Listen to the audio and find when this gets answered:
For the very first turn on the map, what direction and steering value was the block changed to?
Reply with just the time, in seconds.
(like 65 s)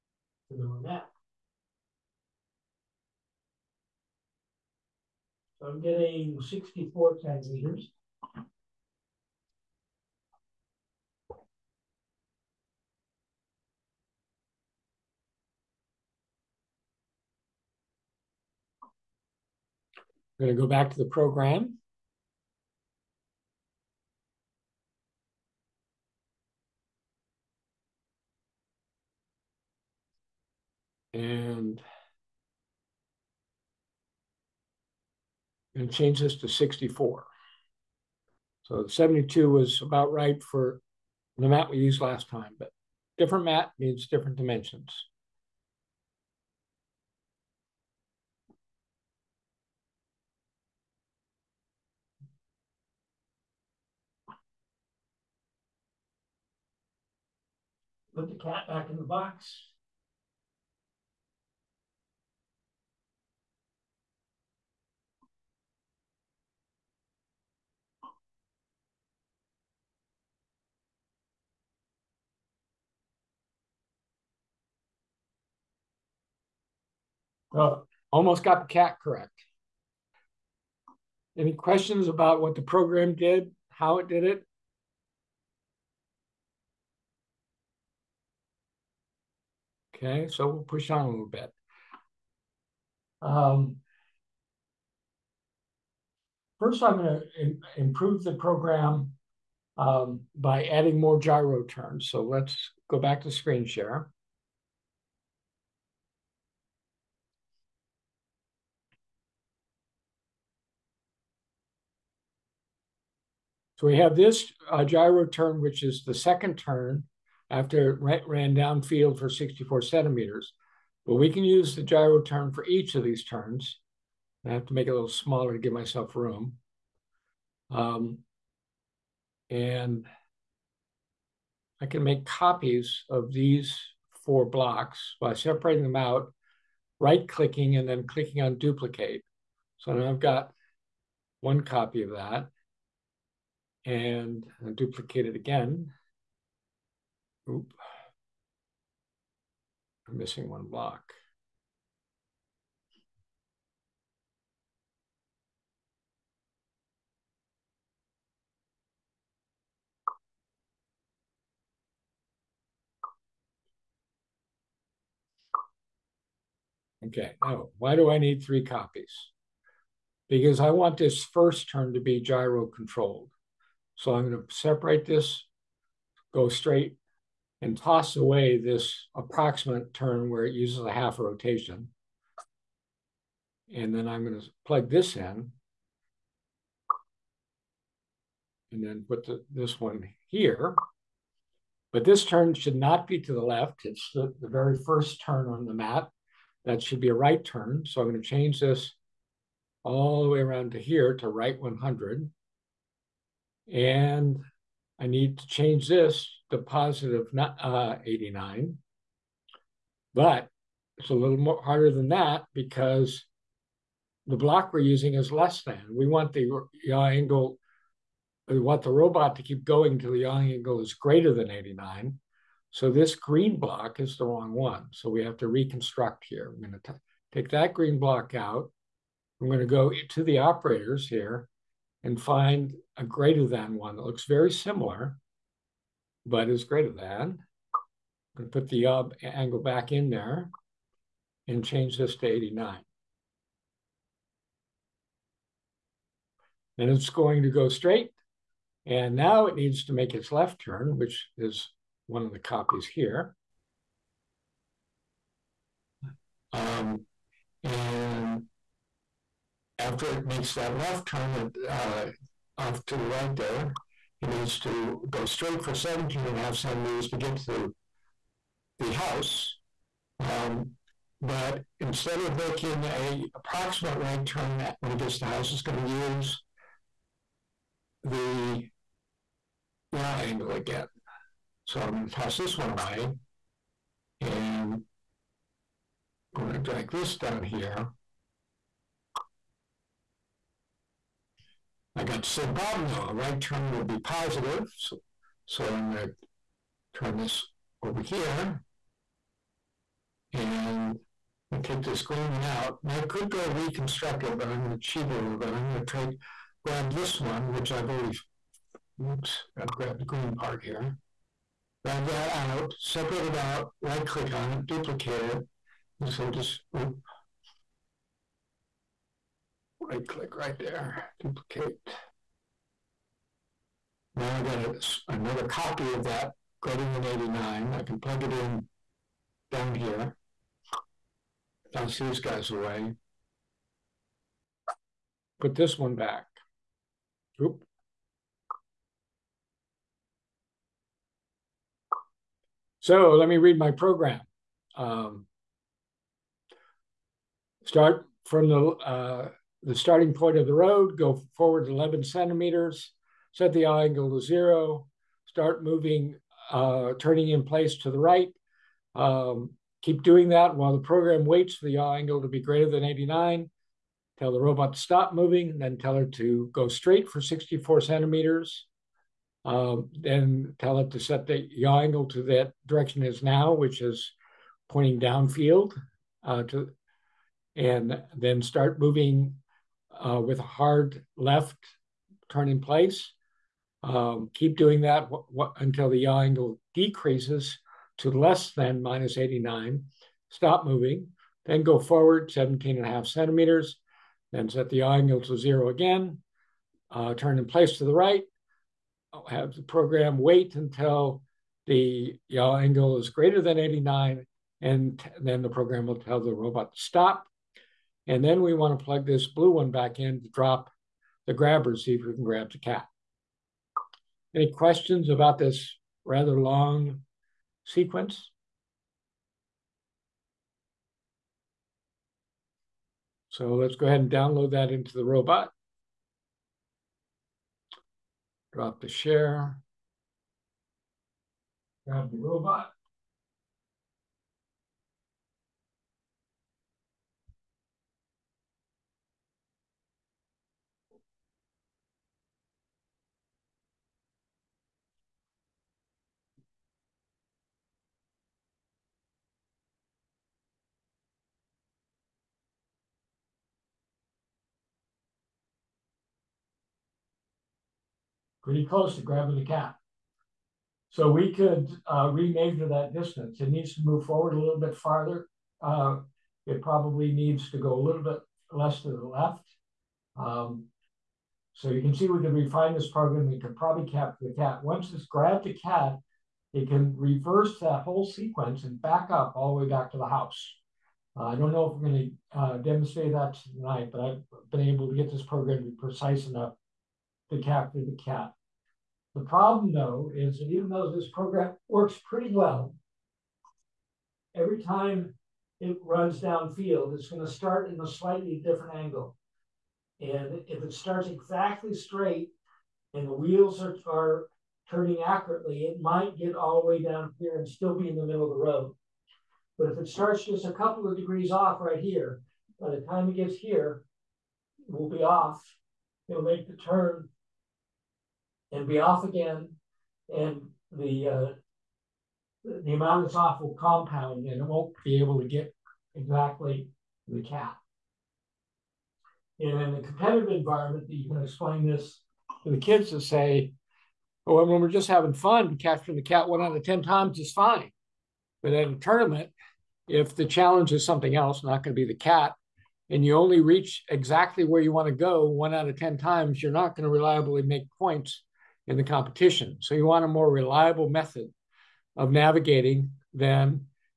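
201 s.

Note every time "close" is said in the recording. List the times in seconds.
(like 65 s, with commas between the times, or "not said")
458 s.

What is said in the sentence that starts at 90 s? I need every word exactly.
Okay, so we'll push on a little bit.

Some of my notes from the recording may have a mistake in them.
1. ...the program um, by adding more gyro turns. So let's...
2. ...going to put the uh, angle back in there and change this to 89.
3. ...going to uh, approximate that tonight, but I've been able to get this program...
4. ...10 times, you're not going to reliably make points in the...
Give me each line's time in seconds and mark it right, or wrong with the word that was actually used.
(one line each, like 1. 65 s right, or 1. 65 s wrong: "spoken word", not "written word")
1. 98 s right
2. 238 s right
3. 481 s wrong: "demonstrate", not "approximate"
4. 545 s right.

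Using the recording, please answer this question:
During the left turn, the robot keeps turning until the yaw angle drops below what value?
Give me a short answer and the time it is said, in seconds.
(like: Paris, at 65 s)
-89, at 388 s.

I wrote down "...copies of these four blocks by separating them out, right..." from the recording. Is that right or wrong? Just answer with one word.
right.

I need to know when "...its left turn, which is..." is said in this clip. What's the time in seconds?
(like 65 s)
250 s.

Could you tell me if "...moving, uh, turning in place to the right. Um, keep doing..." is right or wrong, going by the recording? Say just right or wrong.
right.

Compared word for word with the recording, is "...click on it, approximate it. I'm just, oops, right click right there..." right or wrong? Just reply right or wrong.
wrong.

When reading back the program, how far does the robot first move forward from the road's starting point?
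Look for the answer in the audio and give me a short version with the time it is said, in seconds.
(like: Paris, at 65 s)
11 centimeters, at 351 s.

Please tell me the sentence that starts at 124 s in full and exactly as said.
I have to make it a little smaller to give myself room.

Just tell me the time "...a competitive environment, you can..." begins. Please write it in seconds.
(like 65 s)
529 s.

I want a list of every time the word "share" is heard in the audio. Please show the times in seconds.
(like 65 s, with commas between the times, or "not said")
103 s, 428 s.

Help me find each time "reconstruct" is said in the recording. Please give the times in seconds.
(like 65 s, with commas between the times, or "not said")
225 s, 303 s.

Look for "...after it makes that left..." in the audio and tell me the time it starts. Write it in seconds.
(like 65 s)
259 s.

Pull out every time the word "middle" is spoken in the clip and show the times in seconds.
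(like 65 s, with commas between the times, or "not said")
508 s.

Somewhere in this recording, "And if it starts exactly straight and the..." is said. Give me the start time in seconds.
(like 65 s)
499 s.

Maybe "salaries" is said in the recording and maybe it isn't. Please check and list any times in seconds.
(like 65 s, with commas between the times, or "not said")
not said.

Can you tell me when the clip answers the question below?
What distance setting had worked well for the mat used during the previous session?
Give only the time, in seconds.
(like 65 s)
38 s.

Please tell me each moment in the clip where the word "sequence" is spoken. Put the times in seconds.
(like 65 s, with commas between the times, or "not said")
417 s, 478 s.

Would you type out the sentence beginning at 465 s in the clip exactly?
Uh, it probably needs to go a little bit less to the left.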